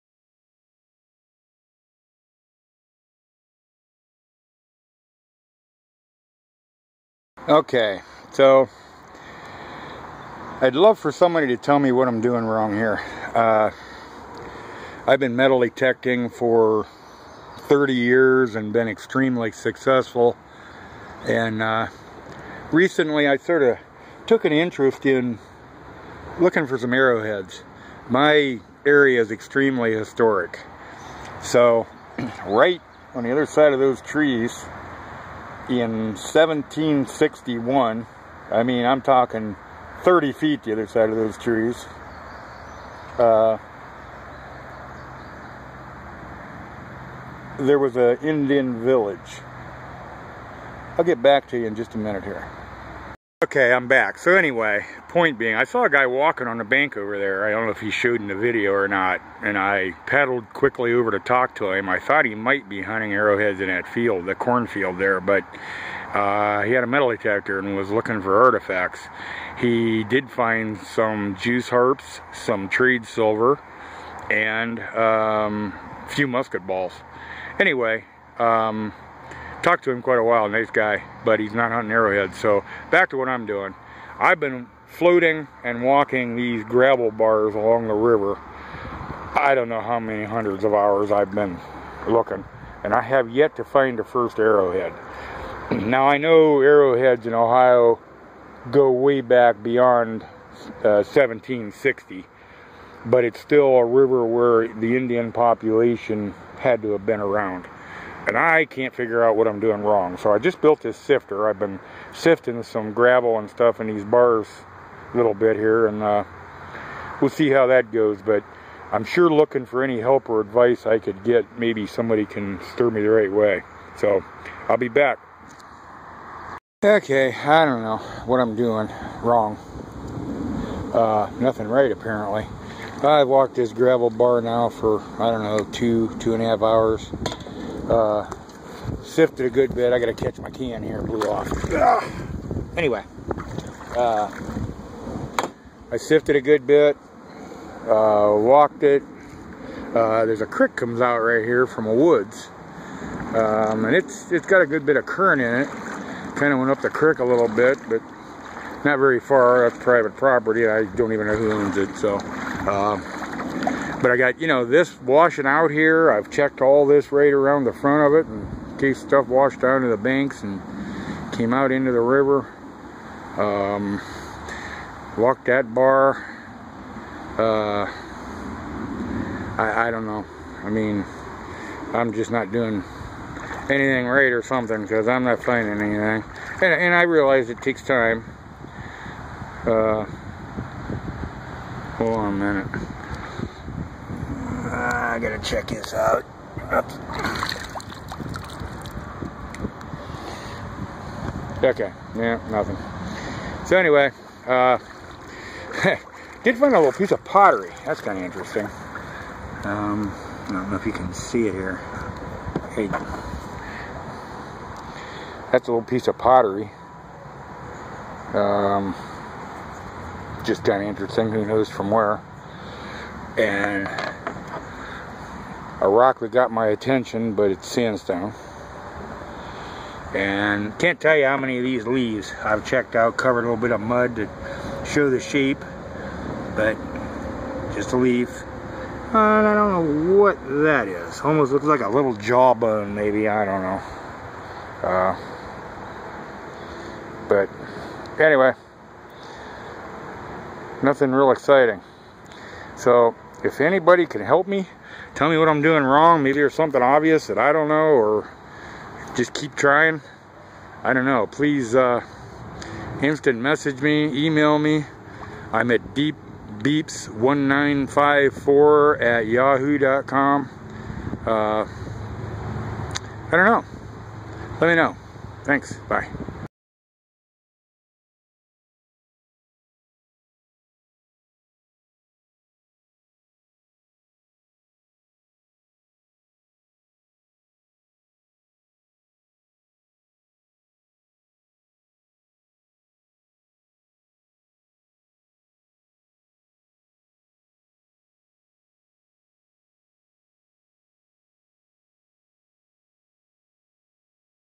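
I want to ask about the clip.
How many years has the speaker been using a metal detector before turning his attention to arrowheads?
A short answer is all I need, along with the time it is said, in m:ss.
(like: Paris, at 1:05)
30, at 0:17.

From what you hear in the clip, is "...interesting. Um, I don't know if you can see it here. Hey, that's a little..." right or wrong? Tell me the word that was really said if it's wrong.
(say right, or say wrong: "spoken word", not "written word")
right.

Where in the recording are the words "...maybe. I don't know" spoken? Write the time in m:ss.
4:02.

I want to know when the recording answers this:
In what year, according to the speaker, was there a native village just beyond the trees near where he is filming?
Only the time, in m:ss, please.
0:36.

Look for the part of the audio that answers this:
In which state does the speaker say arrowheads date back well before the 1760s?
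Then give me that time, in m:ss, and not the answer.
1:37.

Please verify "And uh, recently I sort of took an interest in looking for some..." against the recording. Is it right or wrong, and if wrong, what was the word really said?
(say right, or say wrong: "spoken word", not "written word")
right.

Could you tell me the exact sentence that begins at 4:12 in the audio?
So if anybody can help me tell me what I'm doing wrong.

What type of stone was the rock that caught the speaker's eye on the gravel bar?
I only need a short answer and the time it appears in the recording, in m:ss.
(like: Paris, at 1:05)
sandstone, at 3:47.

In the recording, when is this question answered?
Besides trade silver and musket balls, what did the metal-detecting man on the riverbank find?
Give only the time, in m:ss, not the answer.
1:11.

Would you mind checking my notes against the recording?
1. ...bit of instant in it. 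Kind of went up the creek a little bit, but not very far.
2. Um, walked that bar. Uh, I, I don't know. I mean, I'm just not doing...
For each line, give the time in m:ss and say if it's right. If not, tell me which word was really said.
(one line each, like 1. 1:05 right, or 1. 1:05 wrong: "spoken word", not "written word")
1. 2:34 wrong: "current", not "instant"
2. 2:53 right.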